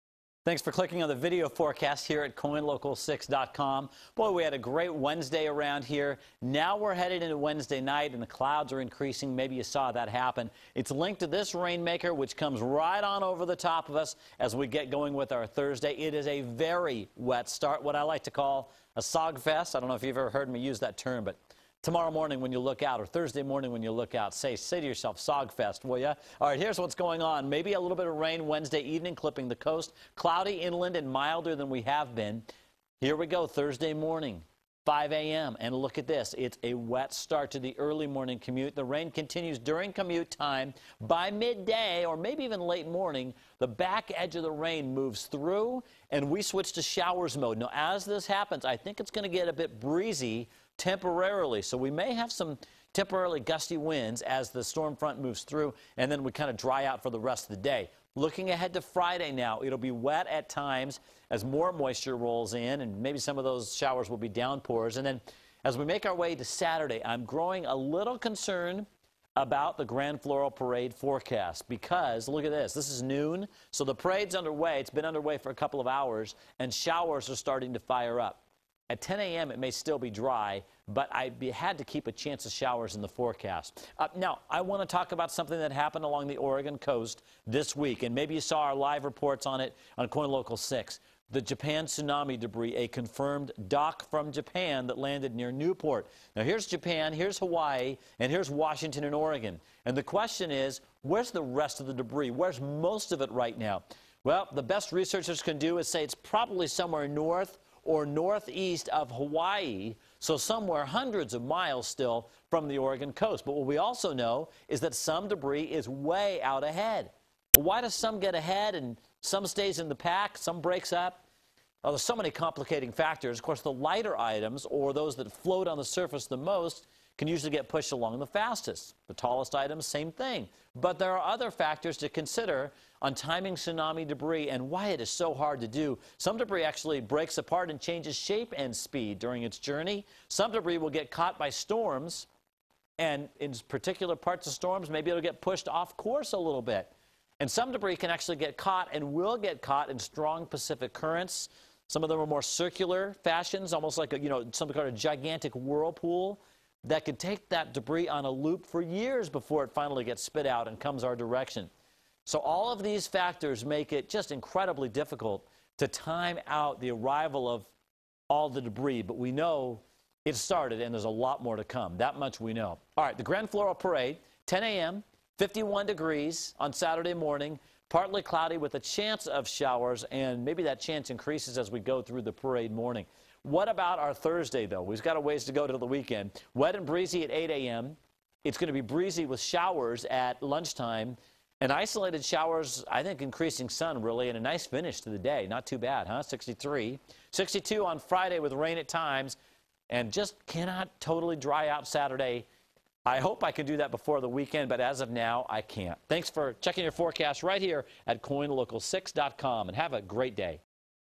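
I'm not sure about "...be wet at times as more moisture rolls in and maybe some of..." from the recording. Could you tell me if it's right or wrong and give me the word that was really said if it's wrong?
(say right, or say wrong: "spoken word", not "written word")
right.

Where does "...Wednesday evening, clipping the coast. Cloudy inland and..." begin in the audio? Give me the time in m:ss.
0:28.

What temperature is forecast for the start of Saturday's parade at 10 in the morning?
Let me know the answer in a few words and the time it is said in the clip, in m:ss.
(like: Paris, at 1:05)
51 degrees, at 2:55.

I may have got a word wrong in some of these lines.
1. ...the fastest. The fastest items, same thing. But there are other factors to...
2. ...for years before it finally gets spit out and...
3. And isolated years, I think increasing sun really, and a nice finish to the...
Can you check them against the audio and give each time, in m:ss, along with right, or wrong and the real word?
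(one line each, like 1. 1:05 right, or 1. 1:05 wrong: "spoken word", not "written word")
1. 2:08 wrong: "tallest", not "fastest"
2. 2:38 right
3. 3:11 wrong: "showers", not "years".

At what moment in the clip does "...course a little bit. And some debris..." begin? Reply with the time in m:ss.
2:25.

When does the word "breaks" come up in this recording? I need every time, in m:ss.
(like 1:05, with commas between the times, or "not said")
2:00, 2:16.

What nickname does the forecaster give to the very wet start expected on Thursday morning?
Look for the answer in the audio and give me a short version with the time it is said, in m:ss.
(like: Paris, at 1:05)
Sogfest, at 0:19.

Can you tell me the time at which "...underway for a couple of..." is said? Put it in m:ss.
1:15.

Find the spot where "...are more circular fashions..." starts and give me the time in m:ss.
2:32.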